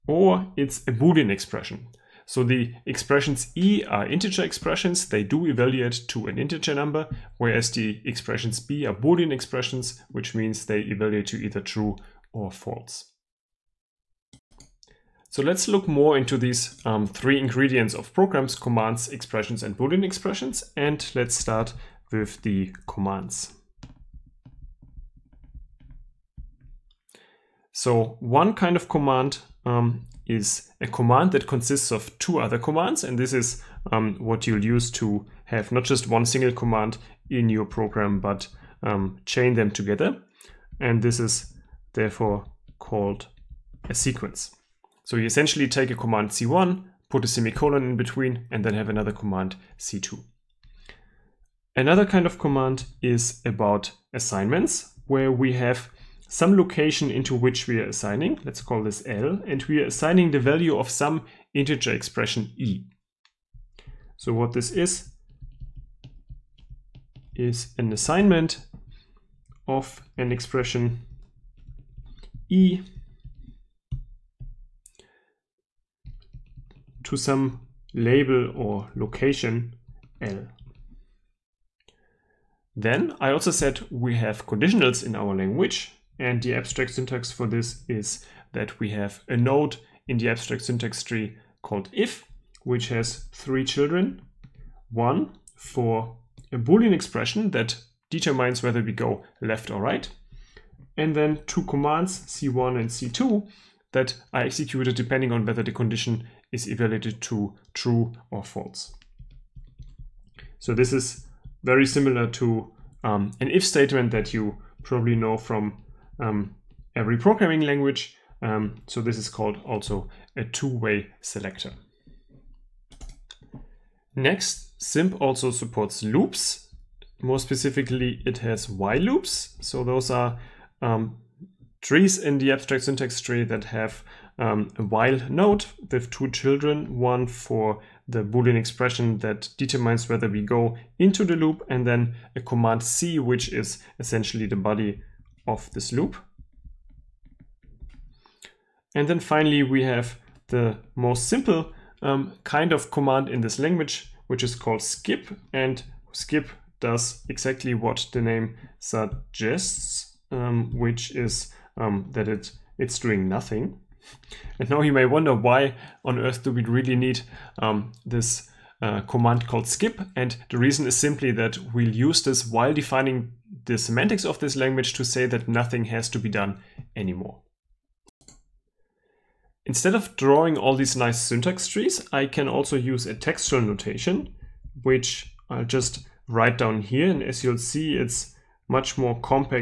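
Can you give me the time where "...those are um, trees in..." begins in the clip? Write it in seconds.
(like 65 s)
129 s.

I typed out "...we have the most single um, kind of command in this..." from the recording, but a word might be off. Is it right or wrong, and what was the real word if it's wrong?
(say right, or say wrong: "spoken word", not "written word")
wrong: "simple", not "single".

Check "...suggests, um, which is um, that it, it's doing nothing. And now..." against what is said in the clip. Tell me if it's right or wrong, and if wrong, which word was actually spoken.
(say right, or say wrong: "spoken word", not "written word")
right.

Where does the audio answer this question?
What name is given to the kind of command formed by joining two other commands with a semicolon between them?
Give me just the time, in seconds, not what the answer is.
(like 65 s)
43 s.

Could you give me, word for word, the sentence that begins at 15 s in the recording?
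So let's look more into these um, three ingredients of programs, commands, expressions, and Boolean expressions.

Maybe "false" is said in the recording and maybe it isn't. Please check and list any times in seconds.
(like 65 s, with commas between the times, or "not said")
12 s, 108 s.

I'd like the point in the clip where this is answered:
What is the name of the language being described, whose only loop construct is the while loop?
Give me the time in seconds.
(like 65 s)
124 s.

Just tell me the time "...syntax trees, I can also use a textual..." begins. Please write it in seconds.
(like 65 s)
181 s.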